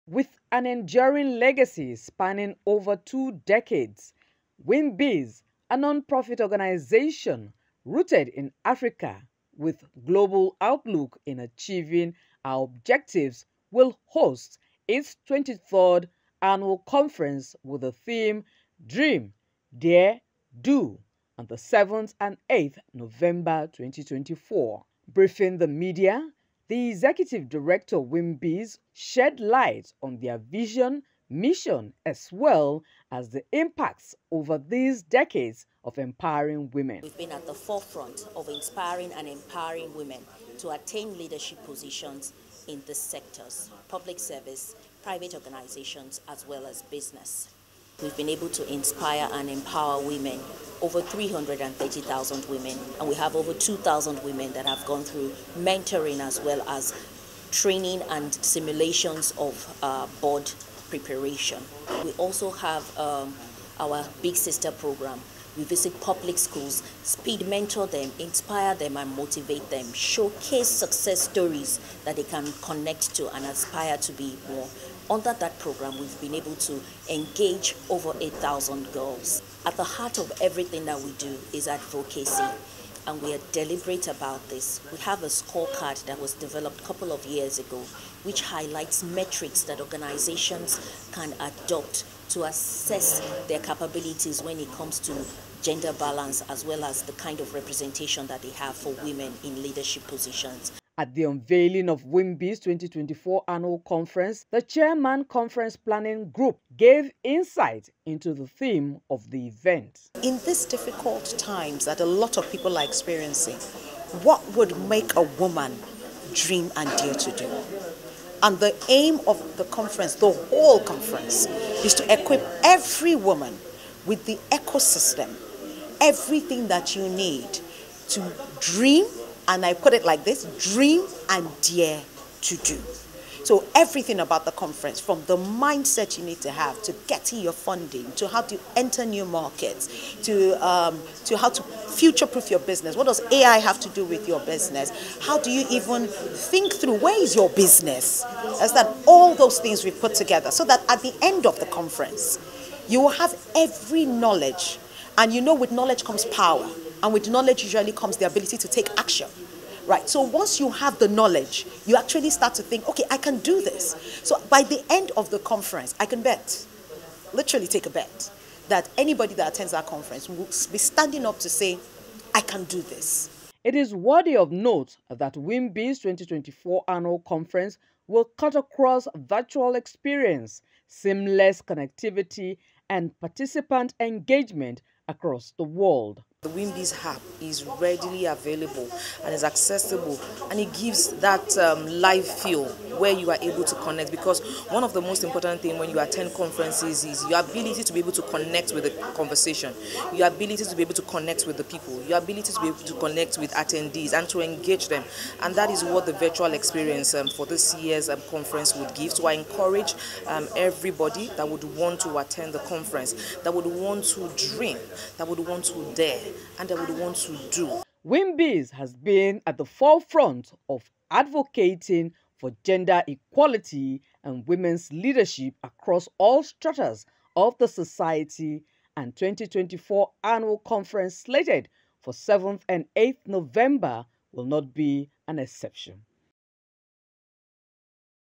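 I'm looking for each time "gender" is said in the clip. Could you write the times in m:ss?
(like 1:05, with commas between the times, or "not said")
1:35, 3:42.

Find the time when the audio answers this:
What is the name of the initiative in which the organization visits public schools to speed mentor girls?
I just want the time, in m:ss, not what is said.
1:04.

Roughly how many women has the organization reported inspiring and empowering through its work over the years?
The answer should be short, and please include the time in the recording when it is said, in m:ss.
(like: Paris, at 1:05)
330,000, at 0:51.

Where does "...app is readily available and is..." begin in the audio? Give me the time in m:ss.
3:07.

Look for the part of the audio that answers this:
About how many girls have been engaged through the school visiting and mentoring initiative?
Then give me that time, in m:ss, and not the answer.
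1:18.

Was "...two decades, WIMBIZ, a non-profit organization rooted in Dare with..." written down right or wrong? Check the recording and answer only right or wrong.
wrong.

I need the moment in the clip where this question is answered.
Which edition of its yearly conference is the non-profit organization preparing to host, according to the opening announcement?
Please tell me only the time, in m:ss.
0:15.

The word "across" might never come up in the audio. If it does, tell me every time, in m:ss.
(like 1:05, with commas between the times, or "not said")
2:58, 3:05, 3:45.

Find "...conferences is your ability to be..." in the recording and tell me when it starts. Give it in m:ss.
3:16.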